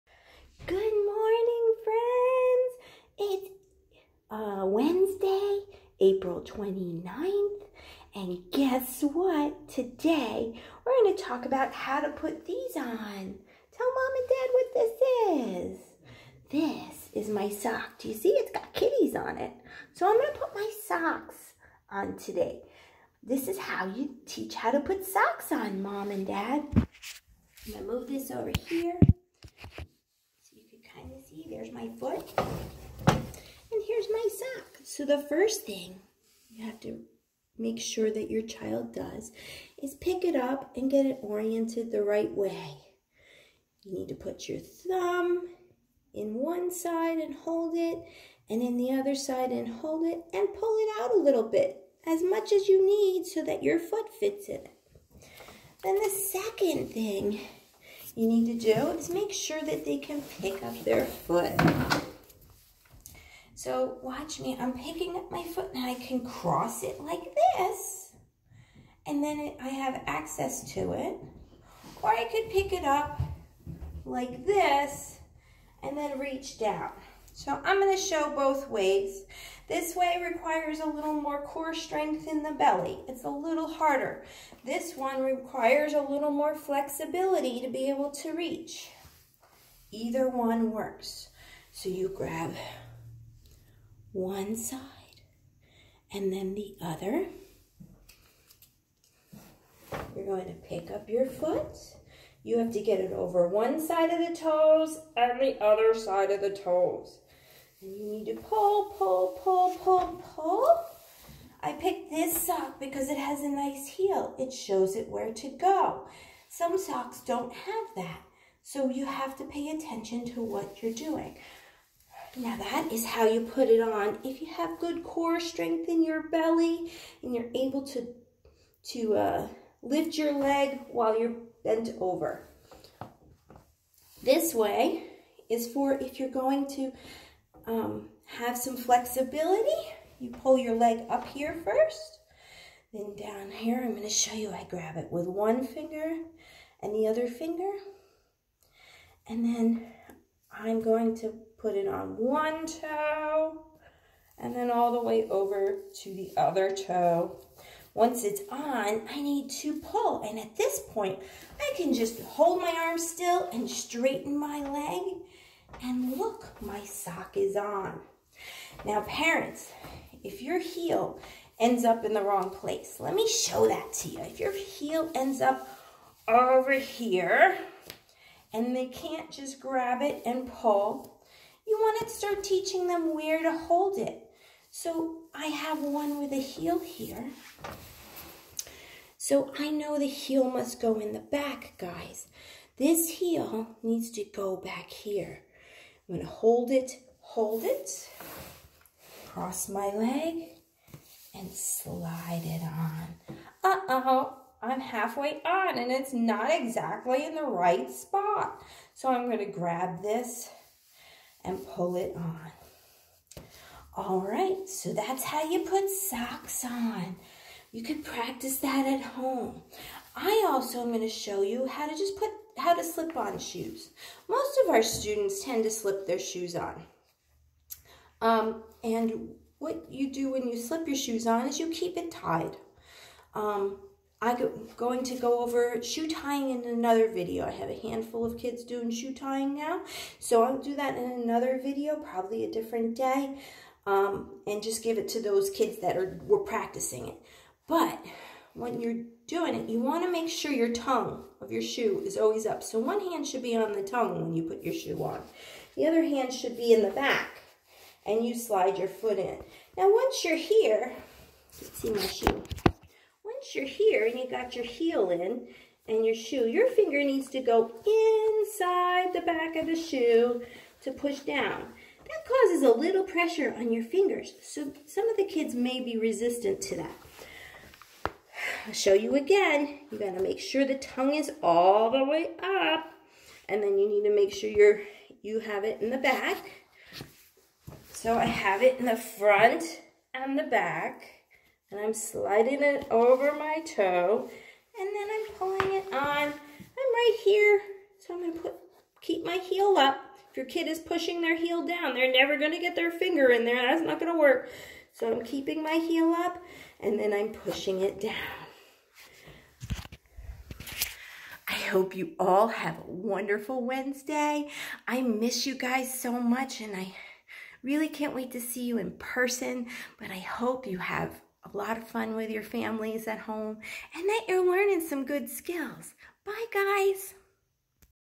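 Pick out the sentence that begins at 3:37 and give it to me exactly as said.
You could practice that at home.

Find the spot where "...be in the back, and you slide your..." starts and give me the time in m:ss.
4:16.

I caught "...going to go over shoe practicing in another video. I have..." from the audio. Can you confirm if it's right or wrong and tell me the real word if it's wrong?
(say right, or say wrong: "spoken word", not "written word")
wrong: "tying", not "practicing".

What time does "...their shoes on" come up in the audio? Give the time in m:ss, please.
3:46.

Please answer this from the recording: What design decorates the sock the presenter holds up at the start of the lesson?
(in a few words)
Kitties.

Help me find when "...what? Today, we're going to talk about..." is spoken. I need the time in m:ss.
0:09.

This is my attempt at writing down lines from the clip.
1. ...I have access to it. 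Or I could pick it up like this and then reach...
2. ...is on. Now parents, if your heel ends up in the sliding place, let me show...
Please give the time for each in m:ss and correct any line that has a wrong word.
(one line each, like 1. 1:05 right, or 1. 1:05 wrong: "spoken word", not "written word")
1. 1:09 right
2. 2:47 wrong: "wrong", not "sliding".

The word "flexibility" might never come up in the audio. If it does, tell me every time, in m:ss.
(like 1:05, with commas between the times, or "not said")
1:26, 2:18.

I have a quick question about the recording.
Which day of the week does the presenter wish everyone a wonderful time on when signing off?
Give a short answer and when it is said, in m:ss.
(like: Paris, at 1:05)
Wednesday, at 5:13.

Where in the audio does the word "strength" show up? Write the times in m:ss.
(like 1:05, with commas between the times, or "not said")
1:21, 2:05.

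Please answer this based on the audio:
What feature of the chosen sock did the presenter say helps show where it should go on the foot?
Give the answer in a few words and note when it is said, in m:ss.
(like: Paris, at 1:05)
A nice heel, at 1:53.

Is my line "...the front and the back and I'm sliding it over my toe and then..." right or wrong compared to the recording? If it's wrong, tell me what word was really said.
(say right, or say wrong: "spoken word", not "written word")
right.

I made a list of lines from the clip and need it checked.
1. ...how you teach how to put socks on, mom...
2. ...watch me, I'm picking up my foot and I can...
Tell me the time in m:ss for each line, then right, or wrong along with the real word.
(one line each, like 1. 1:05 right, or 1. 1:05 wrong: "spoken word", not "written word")
1. 0:23 right
2. 1:04 right.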